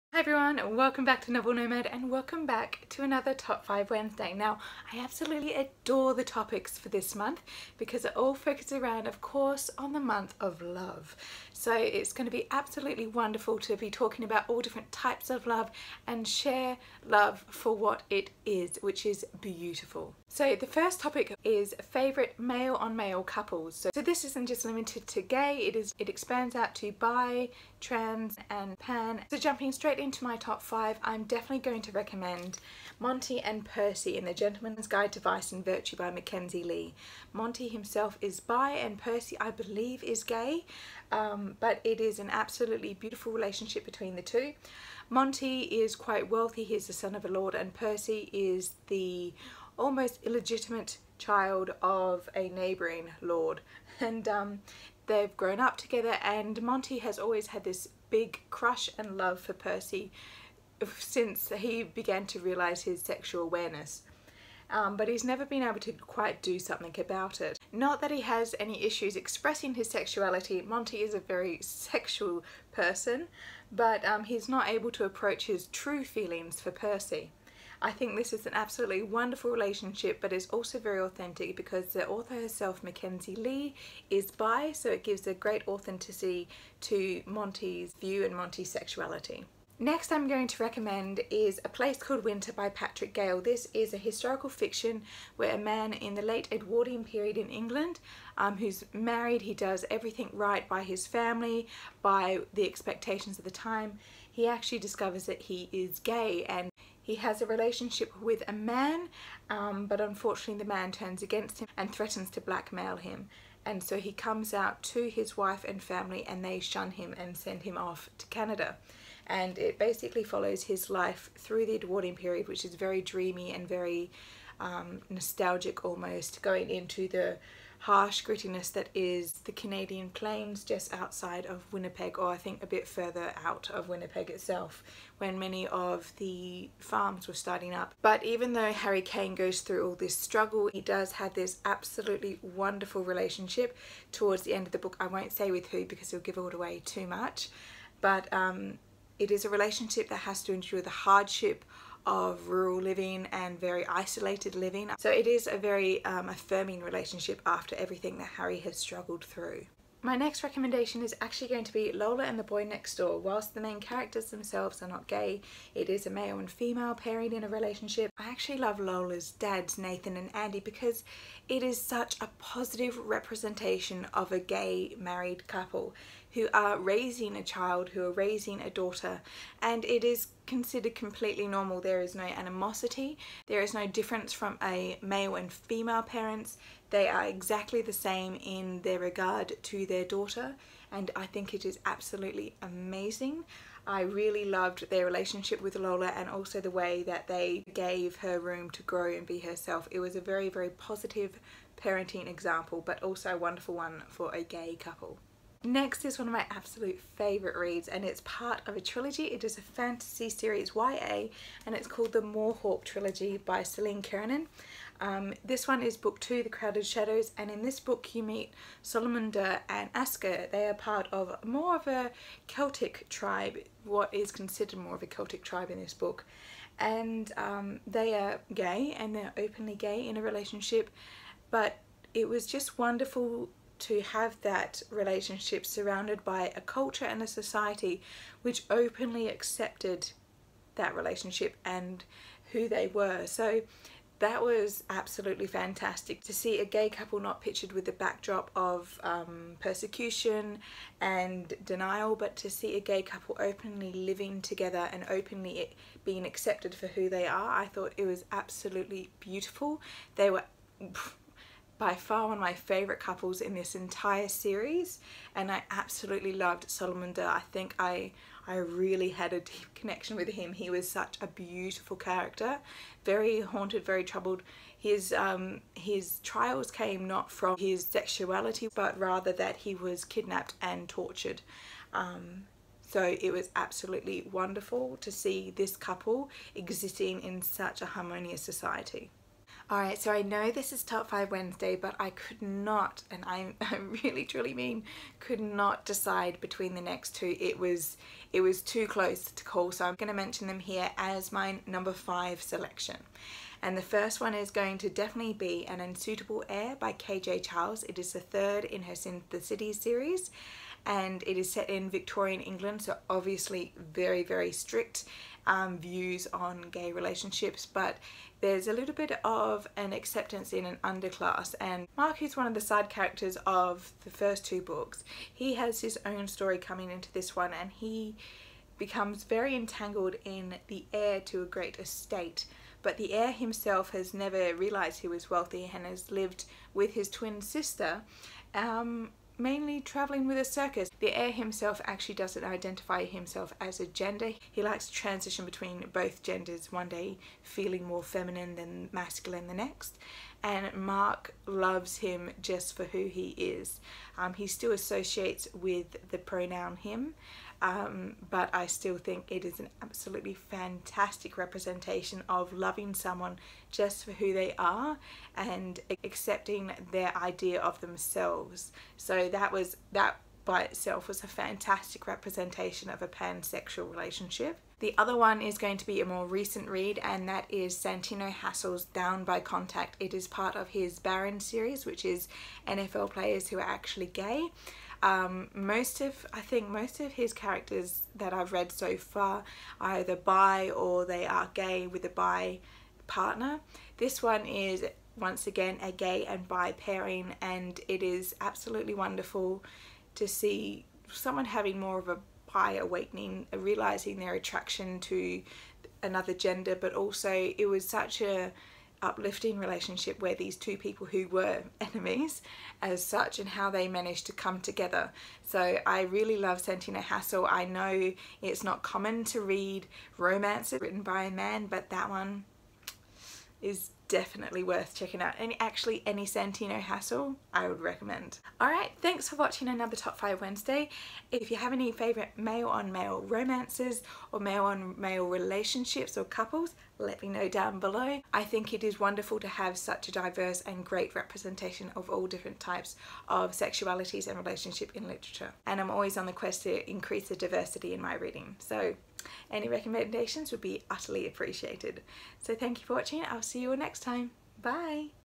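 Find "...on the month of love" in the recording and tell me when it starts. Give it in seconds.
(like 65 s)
9 s.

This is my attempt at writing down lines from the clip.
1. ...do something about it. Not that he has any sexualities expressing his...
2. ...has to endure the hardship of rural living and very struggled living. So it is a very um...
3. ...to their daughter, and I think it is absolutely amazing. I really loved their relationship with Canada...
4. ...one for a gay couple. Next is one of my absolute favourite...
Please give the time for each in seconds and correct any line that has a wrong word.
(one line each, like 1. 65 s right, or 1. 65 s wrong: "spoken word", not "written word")
1. 66 s wrong: "issues", not "sexualities"
2. 150 s wrong: "isolated", not "struggled"
3. 189 s wrong: "Lola", not "Canada"
4. 203 s right.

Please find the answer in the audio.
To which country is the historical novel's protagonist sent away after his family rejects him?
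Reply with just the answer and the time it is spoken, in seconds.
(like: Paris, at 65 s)
Canada, at 118 s.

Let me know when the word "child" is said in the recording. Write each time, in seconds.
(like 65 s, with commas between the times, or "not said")
51 s, 177 s.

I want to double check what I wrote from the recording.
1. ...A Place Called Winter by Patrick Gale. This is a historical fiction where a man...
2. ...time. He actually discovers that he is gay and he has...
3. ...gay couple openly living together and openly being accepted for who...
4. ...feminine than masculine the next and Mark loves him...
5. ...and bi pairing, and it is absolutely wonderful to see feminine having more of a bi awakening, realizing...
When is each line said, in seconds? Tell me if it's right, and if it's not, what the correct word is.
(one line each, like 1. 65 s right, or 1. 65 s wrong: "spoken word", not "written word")
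1. 91 s right
2. 103 s right
3. 252 s right
4. 348 s right
5. 396 s wrong: "someone", not "feminine".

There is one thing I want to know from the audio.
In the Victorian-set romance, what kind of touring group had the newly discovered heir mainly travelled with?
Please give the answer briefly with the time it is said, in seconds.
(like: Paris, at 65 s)
A circus, at 340 s.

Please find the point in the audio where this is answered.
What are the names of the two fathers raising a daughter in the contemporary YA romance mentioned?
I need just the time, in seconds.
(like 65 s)
169 s.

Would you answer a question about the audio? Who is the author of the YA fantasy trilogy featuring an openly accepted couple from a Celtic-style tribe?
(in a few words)
Celine Kiernan.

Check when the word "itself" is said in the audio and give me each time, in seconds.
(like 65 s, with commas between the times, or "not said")
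134 s, 370 s.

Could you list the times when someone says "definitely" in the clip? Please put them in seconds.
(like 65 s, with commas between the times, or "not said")
31 s, 304 s, 424 s.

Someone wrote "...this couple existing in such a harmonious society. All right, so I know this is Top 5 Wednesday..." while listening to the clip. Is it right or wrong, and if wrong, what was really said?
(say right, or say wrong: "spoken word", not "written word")
right.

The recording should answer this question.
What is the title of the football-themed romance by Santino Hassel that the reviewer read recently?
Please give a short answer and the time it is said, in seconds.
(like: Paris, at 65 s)
Down by Contact, at 378 s.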